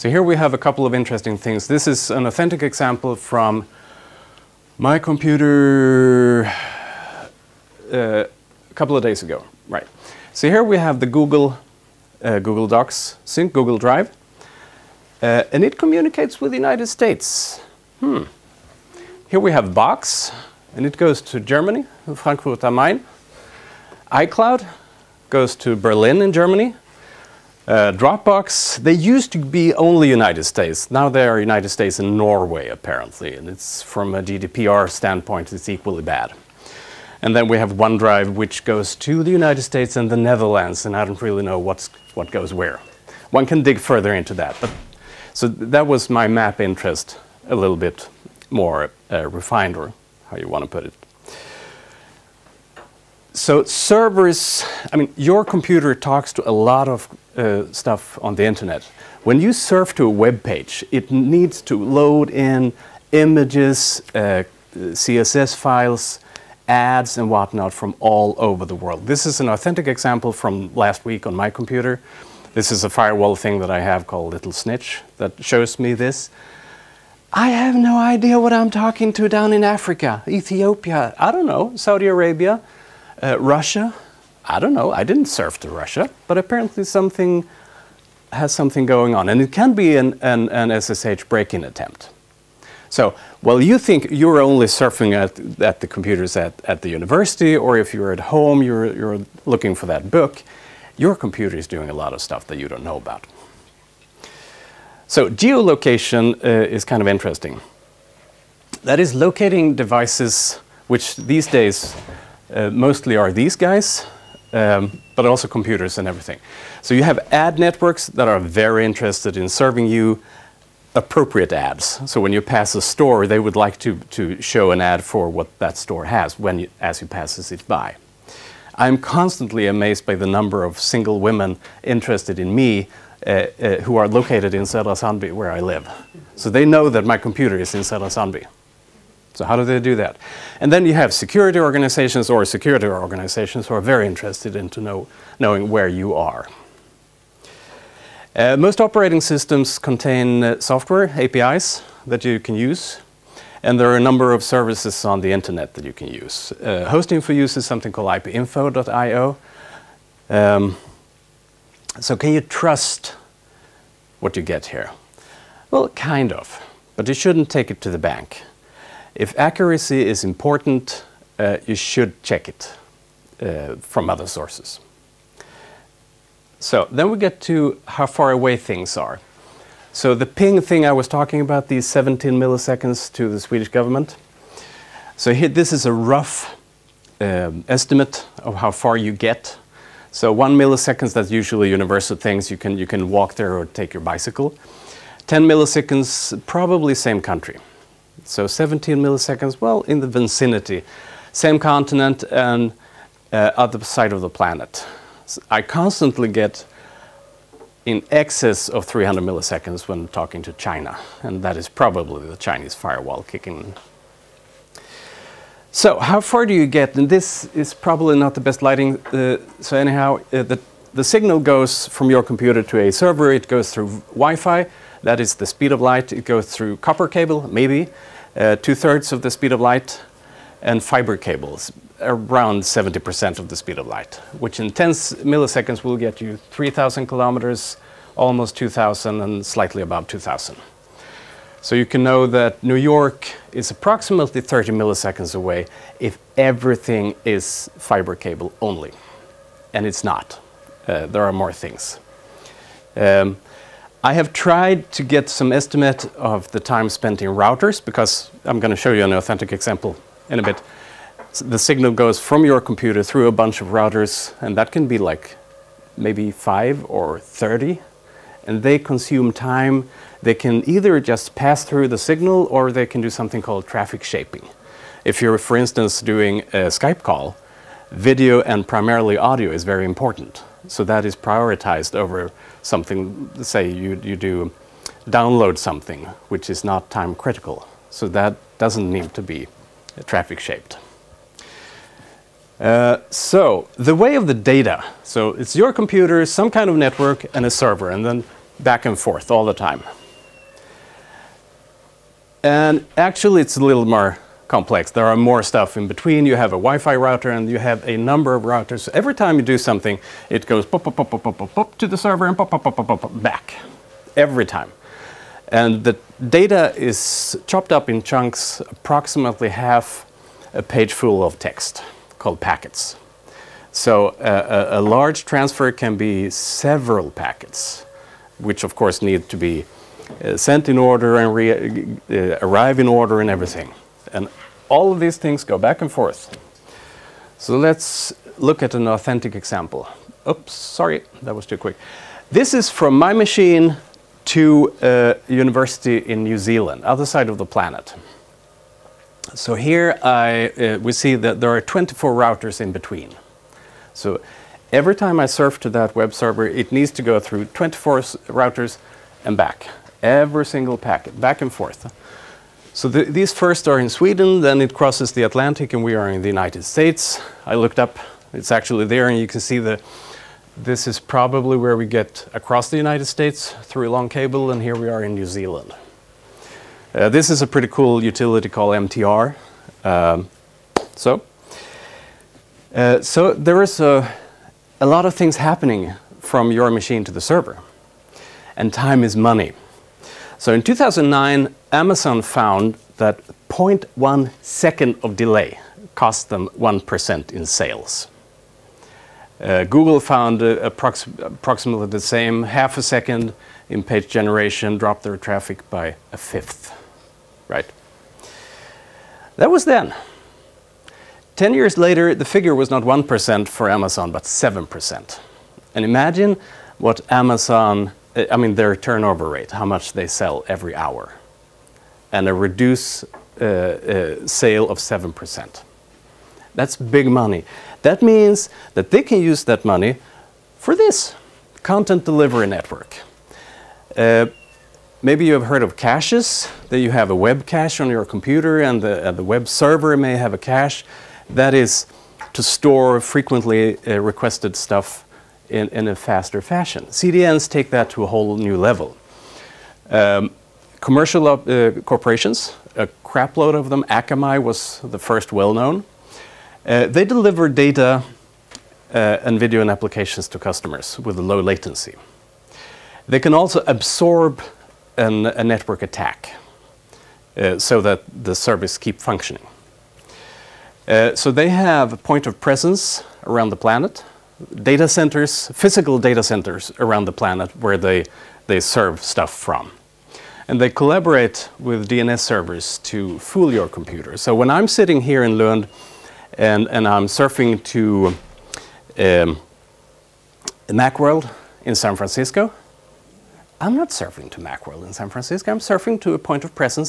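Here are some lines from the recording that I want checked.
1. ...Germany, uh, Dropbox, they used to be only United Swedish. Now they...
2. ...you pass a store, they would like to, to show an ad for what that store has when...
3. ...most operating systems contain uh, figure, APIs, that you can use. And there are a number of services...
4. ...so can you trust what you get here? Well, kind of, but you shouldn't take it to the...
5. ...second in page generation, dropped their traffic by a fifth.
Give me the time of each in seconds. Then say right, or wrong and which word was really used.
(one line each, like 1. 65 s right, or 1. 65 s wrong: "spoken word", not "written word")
1. 26 s wrong: "States", not "Swedish"
2. 122 s right
3. 148 s wrong: "software", not "figure"
4. 162 s right
5. 402 s right.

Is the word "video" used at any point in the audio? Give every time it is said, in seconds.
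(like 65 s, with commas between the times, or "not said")
277 s, 459 s.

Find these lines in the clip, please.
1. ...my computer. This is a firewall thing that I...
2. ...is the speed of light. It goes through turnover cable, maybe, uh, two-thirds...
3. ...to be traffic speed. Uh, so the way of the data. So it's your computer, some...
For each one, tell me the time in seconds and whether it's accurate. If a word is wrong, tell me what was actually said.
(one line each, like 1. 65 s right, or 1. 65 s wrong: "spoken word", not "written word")
1. 71 s right
2. 225 s wrong: "copper", not "turnover"
3. 289 s wrong: "shaped", not "speed".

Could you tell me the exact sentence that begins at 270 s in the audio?
They can either just pass through the signal or they can do something called traffic shaping.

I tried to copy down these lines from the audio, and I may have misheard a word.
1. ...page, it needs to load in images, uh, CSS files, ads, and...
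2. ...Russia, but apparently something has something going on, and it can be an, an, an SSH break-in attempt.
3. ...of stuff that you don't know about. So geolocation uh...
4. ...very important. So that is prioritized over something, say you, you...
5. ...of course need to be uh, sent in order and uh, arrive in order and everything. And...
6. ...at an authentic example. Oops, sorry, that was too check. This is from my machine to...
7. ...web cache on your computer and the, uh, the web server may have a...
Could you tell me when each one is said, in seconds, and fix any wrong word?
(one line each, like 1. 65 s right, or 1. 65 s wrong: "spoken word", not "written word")
1. 60 s right
2. 85 s right
3. 102 s right
4. 279 s right
5. 328 s right
6. 338 s wrong: "quick", not "check"
7. 437 s right.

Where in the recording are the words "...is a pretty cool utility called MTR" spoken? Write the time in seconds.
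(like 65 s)
377 s.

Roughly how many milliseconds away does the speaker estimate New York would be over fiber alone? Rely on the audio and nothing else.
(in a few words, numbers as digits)
30.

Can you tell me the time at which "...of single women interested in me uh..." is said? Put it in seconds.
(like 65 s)
130 s.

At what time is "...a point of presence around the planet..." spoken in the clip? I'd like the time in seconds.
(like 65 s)
471 s.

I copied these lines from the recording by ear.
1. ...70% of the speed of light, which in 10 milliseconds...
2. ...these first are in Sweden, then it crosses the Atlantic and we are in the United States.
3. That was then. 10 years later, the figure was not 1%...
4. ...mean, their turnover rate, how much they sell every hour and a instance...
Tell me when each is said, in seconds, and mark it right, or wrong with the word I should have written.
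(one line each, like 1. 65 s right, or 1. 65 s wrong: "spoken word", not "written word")
1. 232 s right
2. 363 s right
3. 409 s right
4. 418 s wrong: "reduce", not "instance".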